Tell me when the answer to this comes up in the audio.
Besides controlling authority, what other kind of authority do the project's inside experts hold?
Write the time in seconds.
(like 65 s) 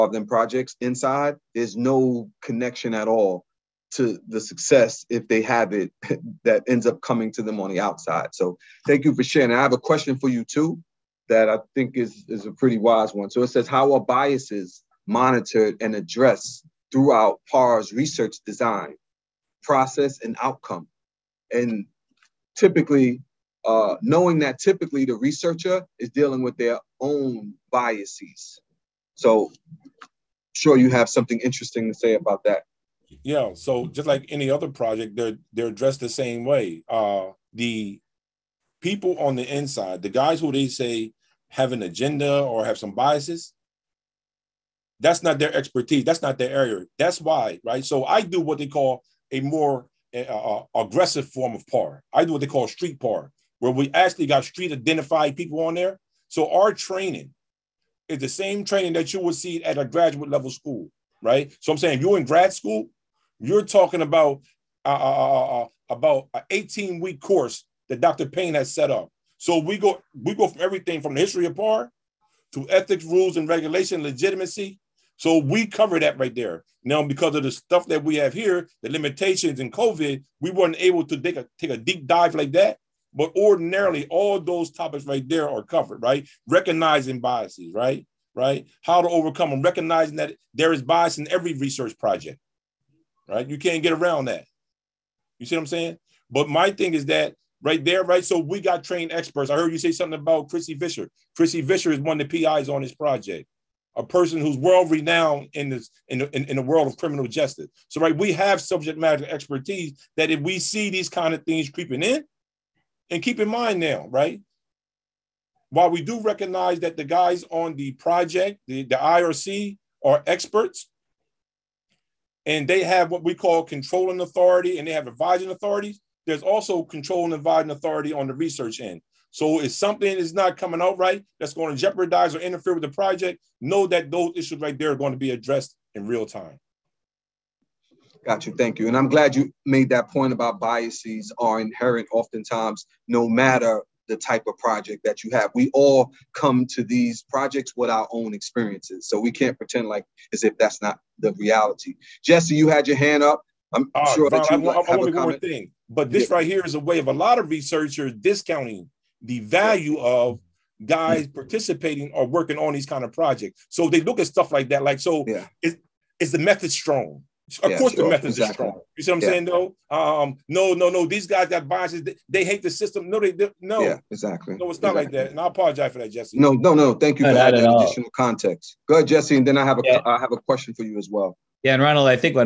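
125 s.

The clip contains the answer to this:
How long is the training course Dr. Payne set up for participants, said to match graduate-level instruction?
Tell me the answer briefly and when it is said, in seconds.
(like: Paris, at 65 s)
18 weeks, at 66 s.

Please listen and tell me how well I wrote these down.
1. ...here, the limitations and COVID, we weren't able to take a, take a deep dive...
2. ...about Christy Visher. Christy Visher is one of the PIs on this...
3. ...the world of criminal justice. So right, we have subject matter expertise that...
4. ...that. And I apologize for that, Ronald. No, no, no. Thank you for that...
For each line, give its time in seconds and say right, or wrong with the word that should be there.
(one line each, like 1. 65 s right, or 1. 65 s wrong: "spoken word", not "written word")
1. 78 s right
2. 100 s right
3. 106 s right
4. 175 s wrong: "Jesse", not "Ronald".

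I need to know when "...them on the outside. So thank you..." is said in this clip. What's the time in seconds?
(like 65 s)
7 s.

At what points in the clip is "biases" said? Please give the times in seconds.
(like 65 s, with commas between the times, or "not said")
13 s, 27 s, 42 s, 87 s, 140 s, 171 s.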